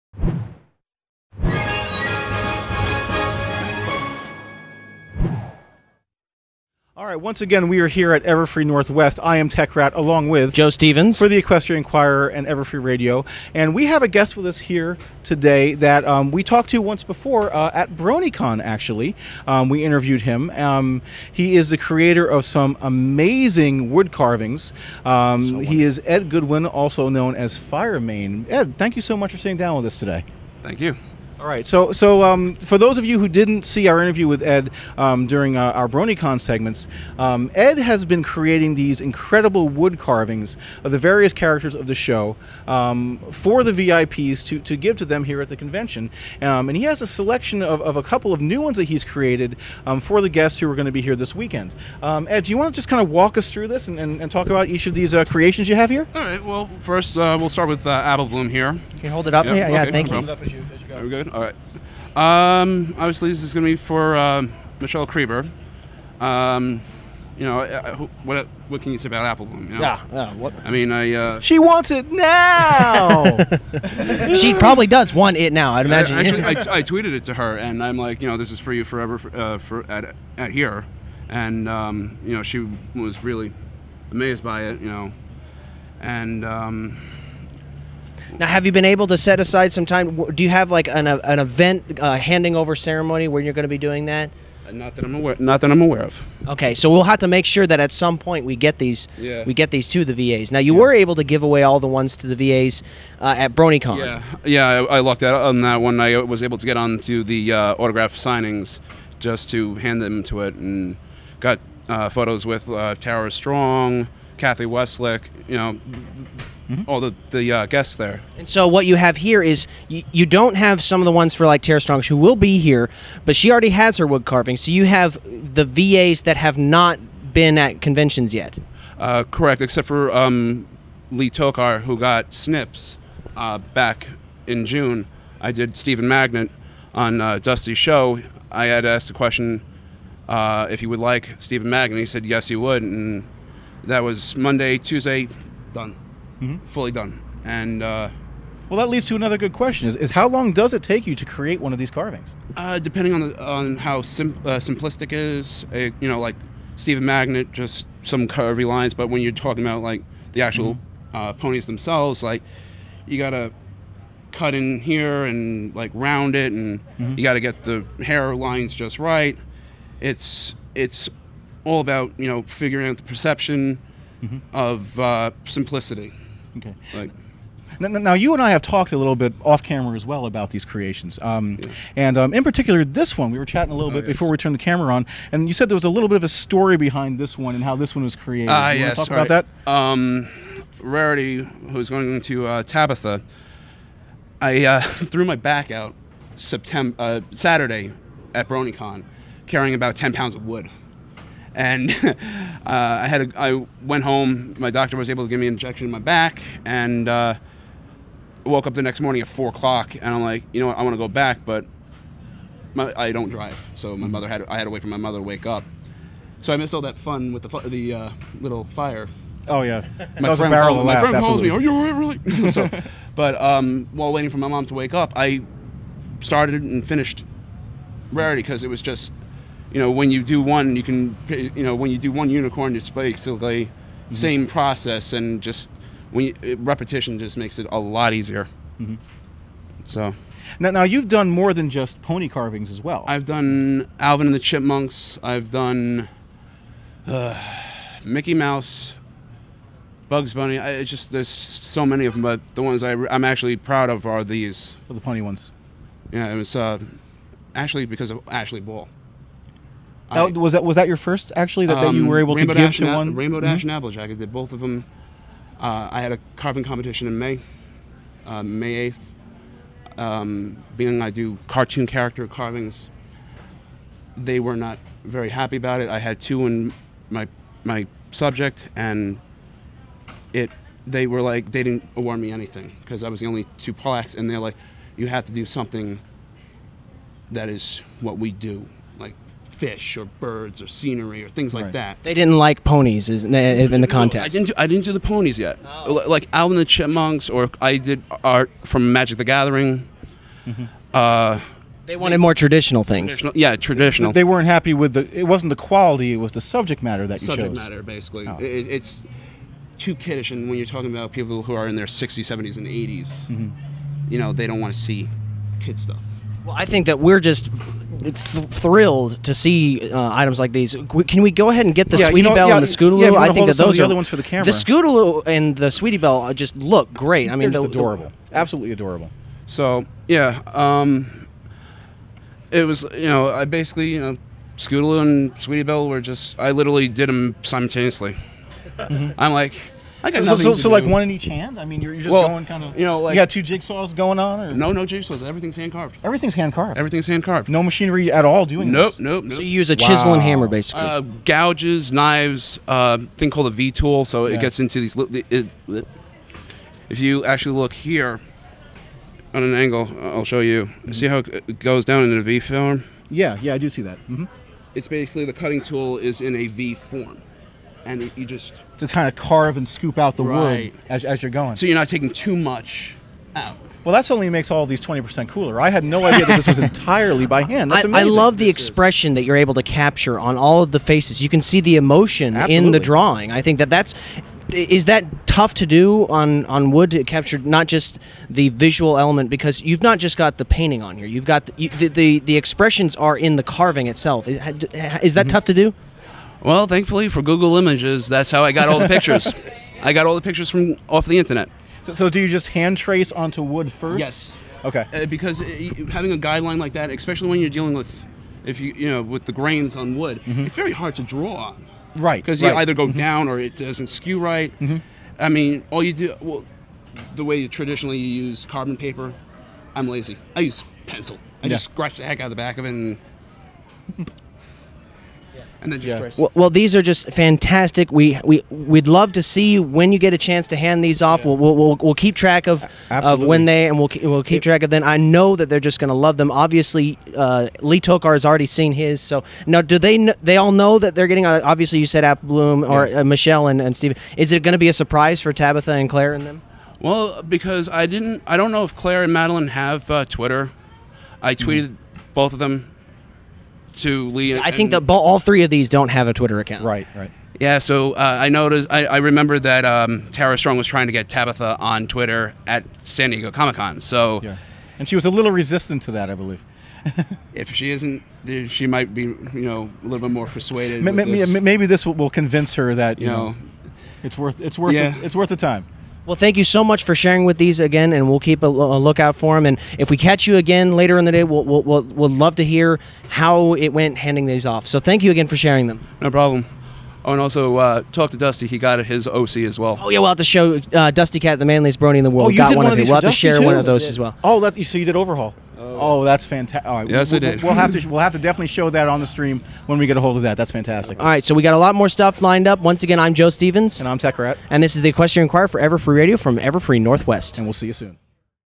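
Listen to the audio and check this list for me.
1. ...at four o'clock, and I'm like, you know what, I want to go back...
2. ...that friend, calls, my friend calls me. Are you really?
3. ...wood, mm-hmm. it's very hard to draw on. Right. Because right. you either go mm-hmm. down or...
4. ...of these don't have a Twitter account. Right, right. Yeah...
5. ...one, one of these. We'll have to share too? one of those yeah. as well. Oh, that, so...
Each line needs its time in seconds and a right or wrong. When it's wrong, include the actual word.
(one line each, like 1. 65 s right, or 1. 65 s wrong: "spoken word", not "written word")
1. 209 s right
2. 220 s right
3. 409 s right
4. 455 s right
5. 492 s right.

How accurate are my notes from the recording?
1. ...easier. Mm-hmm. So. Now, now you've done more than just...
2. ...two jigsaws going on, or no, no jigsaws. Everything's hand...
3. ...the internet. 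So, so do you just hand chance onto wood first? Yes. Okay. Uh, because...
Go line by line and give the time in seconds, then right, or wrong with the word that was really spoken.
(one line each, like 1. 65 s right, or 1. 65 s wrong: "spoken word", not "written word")
1. 238 s right
2. 343 s right
3. 401 s wrong: "trace", not "chance".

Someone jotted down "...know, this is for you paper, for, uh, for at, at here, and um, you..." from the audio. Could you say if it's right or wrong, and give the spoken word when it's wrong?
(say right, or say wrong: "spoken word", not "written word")
wrong: "forever", not "paper".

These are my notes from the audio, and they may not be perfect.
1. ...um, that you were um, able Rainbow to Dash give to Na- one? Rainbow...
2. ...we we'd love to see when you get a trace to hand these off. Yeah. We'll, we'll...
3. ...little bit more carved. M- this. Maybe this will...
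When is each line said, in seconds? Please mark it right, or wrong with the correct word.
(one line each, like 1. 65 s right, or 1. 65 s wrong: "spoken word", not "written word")
1. 261 s right
2. 428 s wrong: "chance", not "trace"
3. 469 s wrong: "persuaded", not "carved".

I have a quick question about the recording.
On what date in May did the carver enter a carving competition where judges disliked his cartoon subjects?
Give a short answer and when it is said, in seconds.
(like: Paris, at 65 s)
May 8, at 268 s.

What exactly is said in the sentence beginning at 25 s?
Um, so he is Ed Goodwin, also known as Firemane.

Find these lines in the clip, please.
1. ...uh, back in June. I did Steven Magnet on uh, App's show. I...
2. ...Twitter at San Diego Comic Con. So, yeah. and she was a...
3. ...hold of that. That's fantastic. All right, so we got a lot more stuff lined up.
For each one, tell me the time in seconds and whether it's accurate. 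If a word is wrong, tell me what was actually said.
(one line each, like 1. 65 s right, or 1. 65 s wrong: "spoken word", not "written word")
1. 133 s wrong: "Dusty", not "App"
2. 461 s right
3. 500 s right.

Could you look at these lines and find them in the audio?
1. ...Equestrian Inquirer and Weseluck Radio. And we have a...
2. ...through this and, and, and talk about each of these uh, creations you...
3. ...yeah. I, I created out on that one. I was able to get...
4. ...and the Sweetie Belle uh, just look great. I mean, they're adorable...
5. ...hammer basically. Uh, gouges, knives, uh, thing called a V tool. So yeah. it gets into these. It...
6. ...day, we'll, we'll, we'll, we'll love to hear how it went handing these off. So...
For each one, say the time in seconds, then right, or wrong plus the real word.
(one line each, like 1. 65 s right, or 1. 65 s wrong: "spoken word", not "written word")
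1. 11 s wrong: "Everfree", not "Weseluck"
2. 53 s right
3. 104 s wrong: "lucked", not "created"
4. 325 s right
5. 350 s right
6. 481 s right.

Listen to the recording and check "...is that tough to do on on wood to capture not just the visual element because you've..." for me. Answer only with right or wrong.
right.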